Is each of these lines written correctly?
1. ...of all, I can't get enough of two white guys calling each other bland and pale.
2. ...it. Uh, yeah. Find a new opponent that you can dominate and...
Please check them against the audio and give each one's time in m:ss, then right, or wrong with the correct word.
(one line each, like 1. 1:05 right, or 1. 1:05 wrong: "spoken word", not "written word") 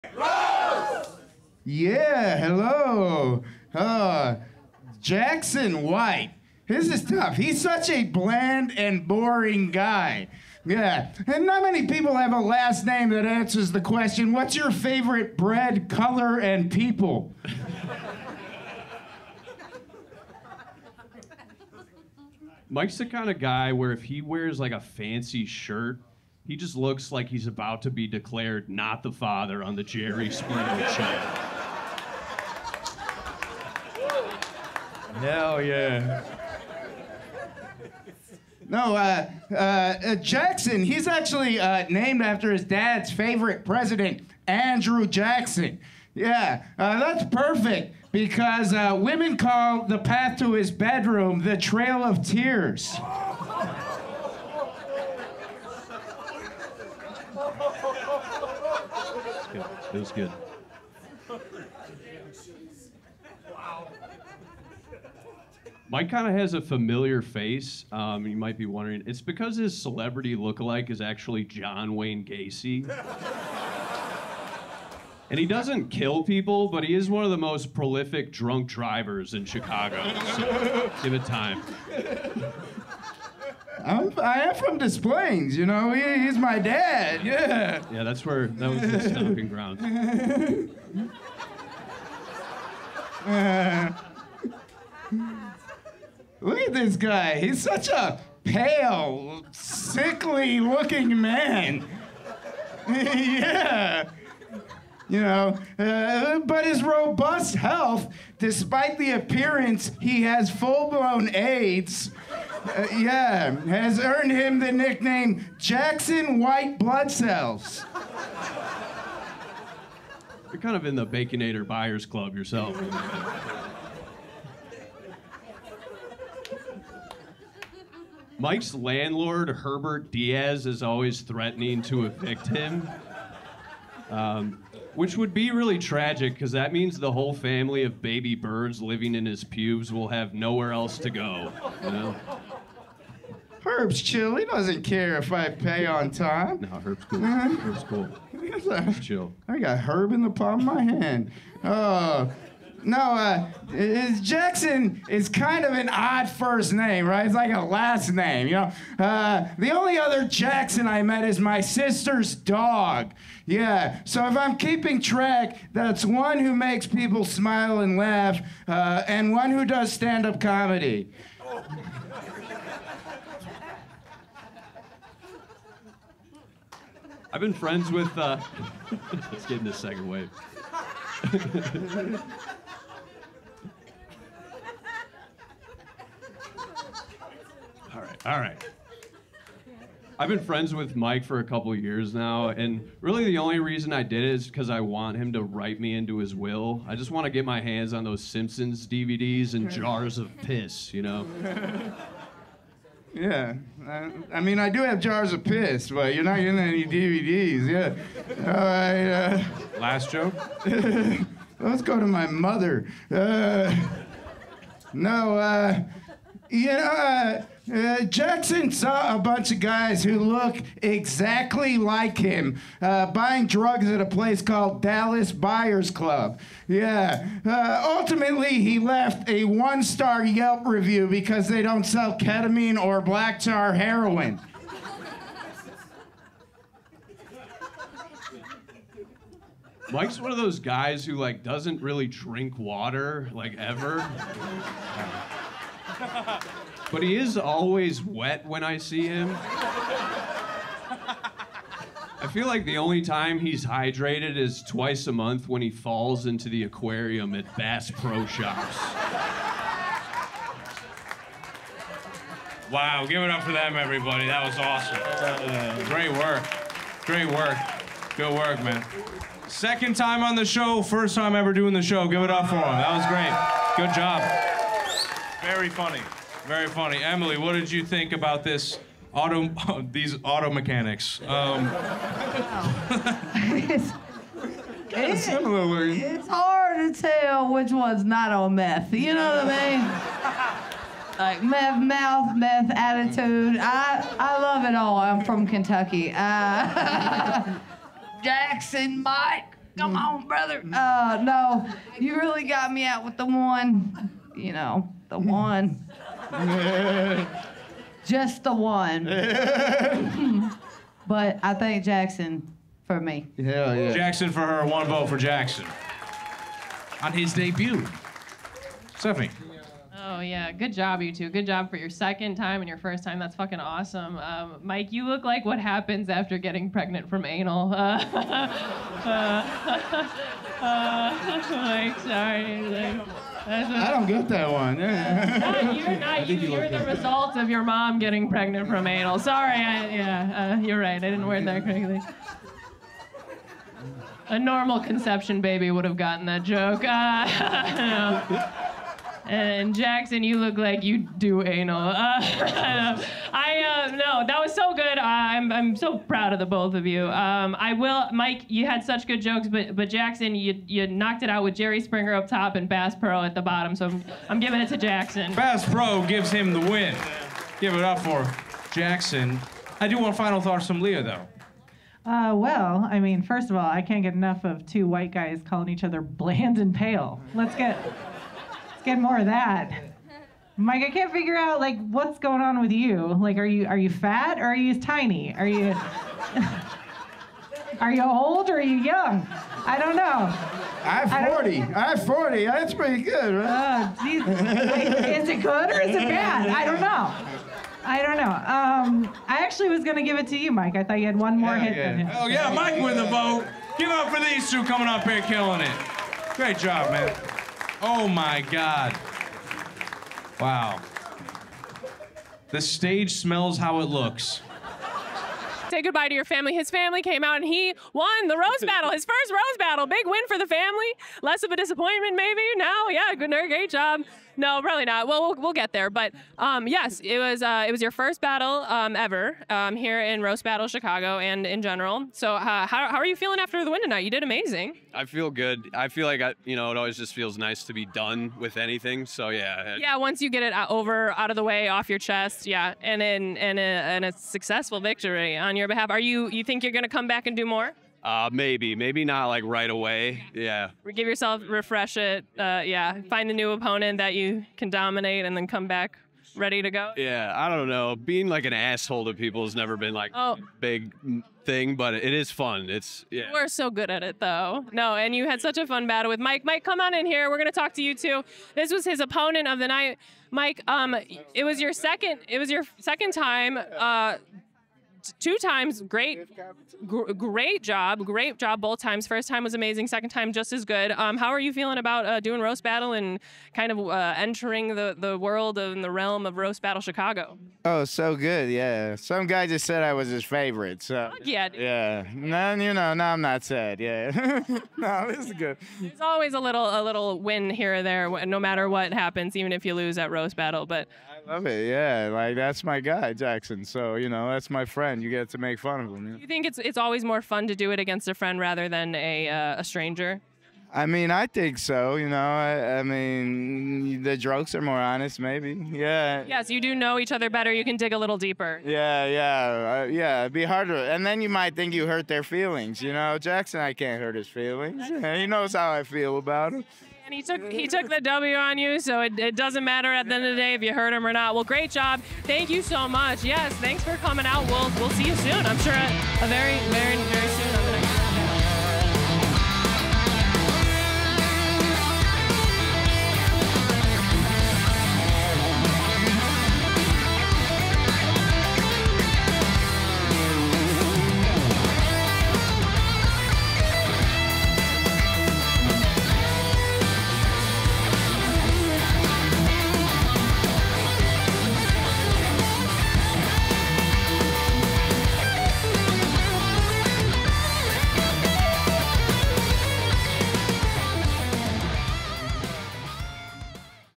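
1. 6:13 right
2. 7:31 right.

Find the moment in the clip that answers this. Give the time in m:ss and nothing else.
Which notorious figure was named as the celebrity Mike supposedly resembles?
1:11.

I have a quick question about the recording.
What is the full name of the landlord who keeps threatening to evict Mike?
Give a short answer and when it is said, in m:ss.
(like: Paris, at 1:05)
Herbert Diaz, at 2:09.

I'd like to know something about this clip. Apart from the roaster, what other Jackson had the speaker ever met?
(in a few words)
Sister's dog.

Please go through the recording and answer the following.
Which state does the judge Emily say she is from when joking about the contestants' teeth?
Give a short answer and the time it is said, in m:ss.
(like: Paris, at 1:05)
Kentucky, at 4:55.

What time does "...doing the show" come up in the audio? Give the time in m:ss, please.
4:31.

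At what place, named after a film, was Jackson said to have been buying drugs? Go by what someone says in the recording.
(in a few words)
Dallas Buyers Club.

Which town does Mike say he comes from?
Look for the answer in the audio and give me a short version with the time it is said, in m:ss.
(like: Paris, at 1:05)
Des Plaines, at 1:24.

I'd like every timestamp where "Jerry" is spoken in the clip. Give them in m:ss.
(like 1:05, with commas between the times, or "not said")
0:29, 6:01.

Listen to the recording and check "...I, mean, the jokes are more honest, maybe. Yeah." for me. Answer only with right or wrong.
right.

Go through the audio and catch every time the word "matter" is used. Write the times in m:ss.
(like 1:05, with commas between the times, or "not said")
8:18, 8:49.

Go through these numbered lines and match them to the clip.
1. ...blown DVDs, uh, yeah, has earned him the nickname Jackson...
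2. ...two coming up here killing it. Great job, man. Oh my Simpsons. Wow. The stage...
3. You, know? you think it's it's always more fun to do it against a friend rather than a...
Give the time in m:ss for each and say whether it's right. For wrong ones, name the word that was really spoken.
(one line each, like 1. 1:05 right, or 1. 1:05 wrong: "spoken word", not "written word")
1. 1:50 wrong: "AIDS", not "DVDs"
2. 6:44 wrong: "God", not "Simpsons"
3. 8:26 right.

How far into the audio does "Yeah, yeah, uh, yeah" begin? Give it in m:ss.
8:38.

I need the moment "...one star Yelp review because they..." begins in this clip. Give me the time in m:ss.
3:49.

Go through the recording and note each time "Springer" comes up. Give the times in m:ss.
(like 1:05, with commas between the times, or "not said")
0:30, 6:01.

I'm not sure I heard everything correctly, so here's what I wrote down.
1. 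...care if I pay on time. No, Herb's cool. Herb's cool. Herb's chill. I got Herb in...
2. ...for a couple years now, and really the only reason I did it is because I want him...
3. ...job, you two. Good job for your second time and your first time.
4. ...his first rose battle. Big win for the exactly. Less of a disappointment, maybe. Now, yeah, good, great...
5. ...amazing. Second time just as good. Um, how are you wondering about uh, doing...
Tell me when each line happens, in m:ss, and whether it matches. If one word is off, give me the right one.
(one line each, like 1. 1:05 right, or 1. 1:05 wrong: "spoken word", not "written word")
1. 2:24 right
2. 3:11 right
3. 5:20 right
4. 6:58 wrong: "family", not "exactly"
5. 7:59 wrong: "feeling", not "wondering".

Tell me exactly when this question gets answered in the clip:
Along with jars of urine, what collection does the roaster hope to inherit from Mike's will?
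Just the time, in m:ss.
3:18.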